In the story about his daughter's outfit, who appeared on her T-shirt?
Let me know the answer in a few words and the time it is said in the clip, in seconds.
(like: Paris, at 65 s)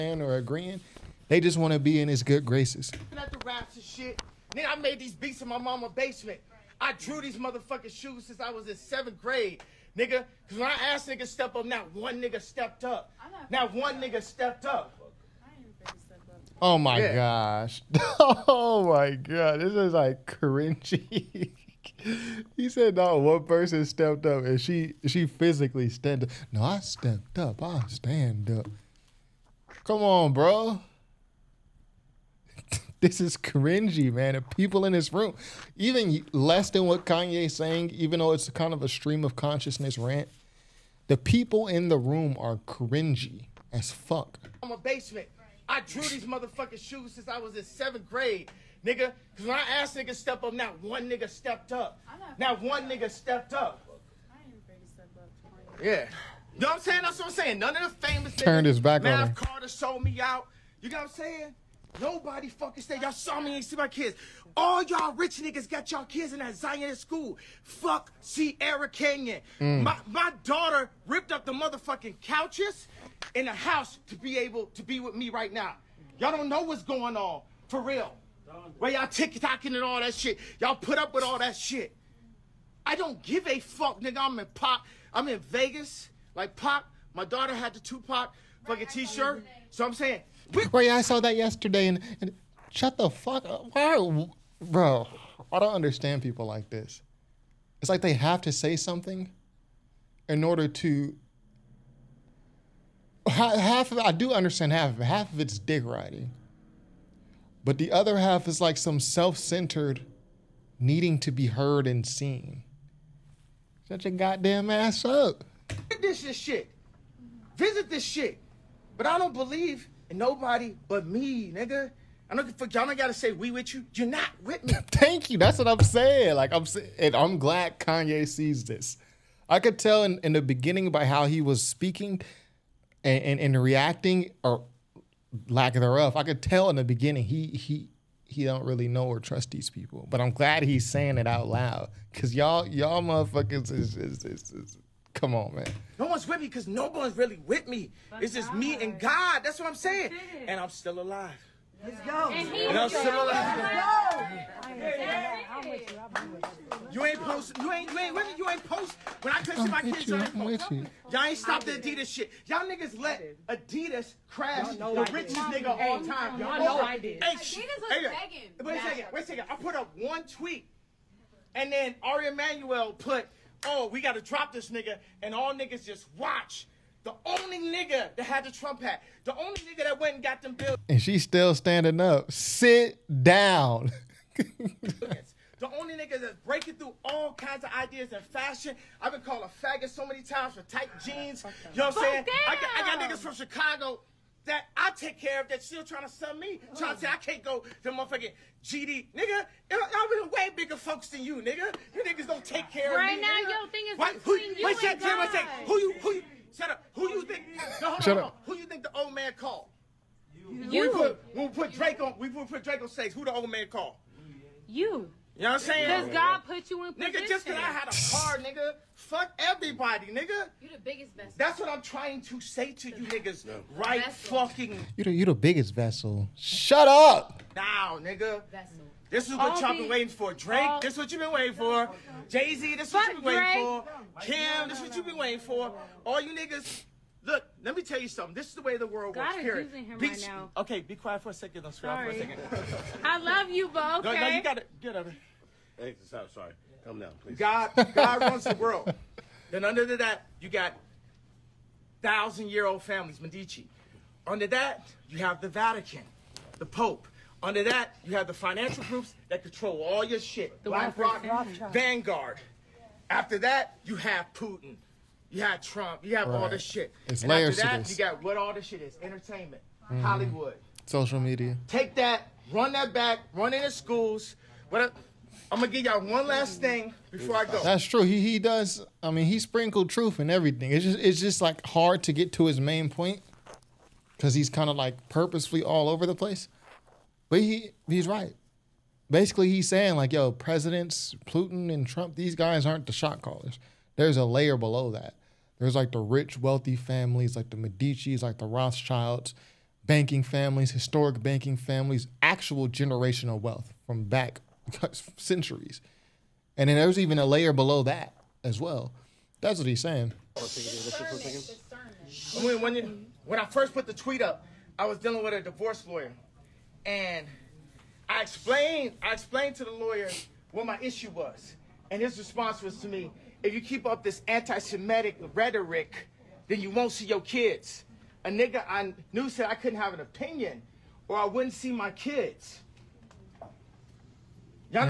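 Tupac, at 87 s.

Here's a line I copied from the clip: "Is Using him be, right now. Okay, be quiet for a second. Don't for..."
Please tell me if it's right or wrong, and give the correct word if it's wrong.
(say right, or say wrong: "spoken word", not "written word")
right.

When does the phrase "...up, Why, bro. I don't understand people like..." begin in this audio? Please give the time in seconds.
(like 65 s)
93 s.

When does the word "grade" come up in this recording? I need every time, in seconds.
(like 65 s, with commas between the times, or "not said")
9 s, 48 s.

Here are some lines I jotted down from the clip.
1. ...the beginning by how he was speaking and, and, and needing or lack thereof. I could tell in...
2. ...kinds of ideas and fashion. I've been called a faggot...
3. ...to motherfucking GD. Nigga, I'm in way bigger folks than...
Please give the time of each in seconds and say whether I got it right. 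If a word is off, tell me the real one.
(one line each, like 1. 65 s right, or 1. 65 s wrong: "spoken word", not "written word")
1. 130 s wrong: "reacting", not "needing"
2. 187 s right
3. 197 s right.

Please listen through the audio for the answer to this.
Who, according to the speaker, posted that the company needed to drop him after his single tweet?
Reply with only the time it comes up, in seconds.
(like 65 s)
172 s.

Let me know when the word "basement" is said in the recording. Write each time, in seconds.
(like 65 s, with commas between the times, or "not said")
5 s, 44 s.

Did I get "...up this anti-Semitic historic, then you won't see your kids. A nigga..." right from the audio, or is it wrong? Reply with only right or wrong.
wrong.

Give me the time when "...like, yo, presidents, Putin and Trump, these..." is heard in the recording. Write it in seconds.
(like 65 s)
289 s.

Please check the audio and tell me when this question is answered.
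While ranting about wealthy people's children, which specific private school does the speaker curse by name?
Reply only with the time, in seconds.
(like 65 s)
68 s.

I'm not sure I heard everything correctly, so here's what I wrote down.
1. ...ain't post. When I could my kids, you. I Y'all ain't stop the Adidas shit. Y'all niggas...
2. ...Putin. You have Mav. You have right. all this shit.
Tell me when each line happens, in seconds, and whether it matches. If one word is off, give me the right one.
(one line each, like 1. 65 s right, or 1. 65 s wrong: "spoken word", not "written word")
1. 158 s right
2. 264 s wrong: "Trump", not "Mav".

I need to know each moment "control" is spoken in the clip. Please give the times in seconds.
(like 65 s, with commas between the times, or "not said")
259 s.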